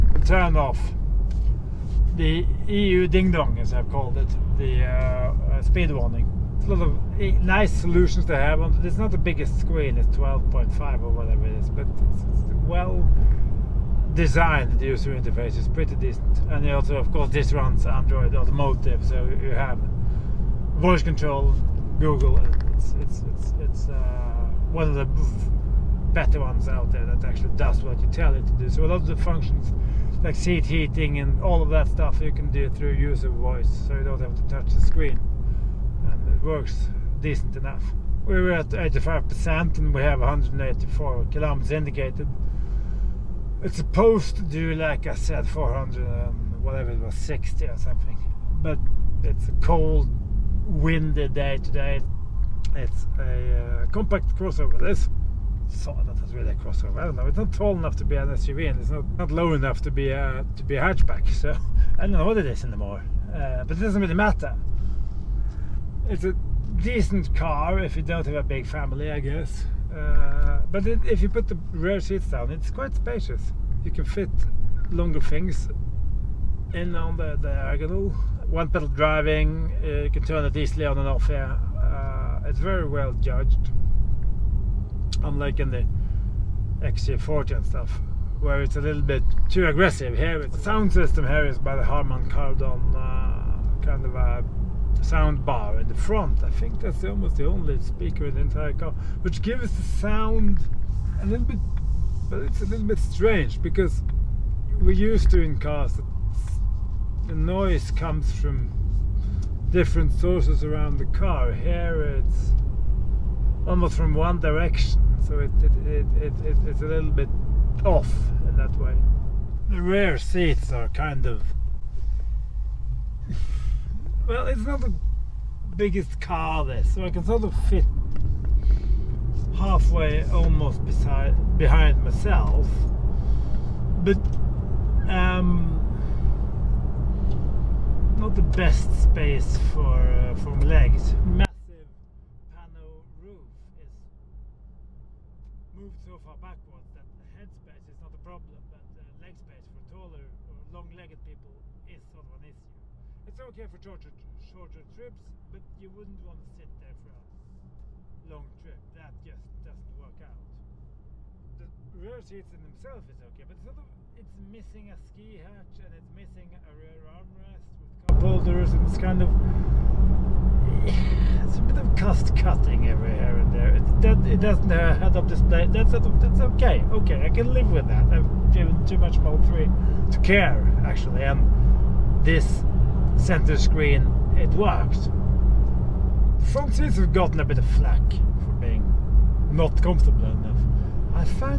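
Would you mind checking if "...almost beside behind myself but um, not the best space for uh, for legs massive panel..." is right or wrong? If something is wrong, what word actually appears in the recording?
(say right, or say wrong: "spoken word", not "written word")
right.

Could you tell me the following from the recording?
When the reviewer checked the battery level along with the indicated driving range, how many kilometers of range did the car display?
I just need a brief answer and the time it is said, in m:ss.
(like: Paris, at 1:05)
184, at 0:40.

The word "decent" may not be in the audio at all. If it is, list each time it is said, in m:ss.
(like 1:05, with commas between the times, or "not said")
0:15, 0:37, 1:06.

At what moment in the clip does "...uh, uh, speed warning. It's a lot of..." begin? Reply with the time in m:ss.
0:04.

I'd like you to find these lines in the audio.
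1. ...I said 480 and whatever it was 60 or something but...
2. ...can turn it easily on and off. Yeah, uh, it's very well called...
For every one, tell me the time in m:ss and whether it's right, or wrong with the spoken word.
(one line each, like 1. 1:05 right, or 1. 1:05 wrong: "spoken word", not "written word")
1. 0:45 wrong: "400", not "480"
2. 1:20 wrong: "judged", not "called".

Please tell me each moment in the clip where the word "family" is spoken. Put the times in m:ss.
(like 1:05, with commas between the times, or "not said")
1:08.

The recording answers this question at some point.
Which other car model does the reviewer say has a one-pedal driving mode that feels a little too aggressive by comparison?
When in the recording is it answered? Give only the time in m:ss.
1:26.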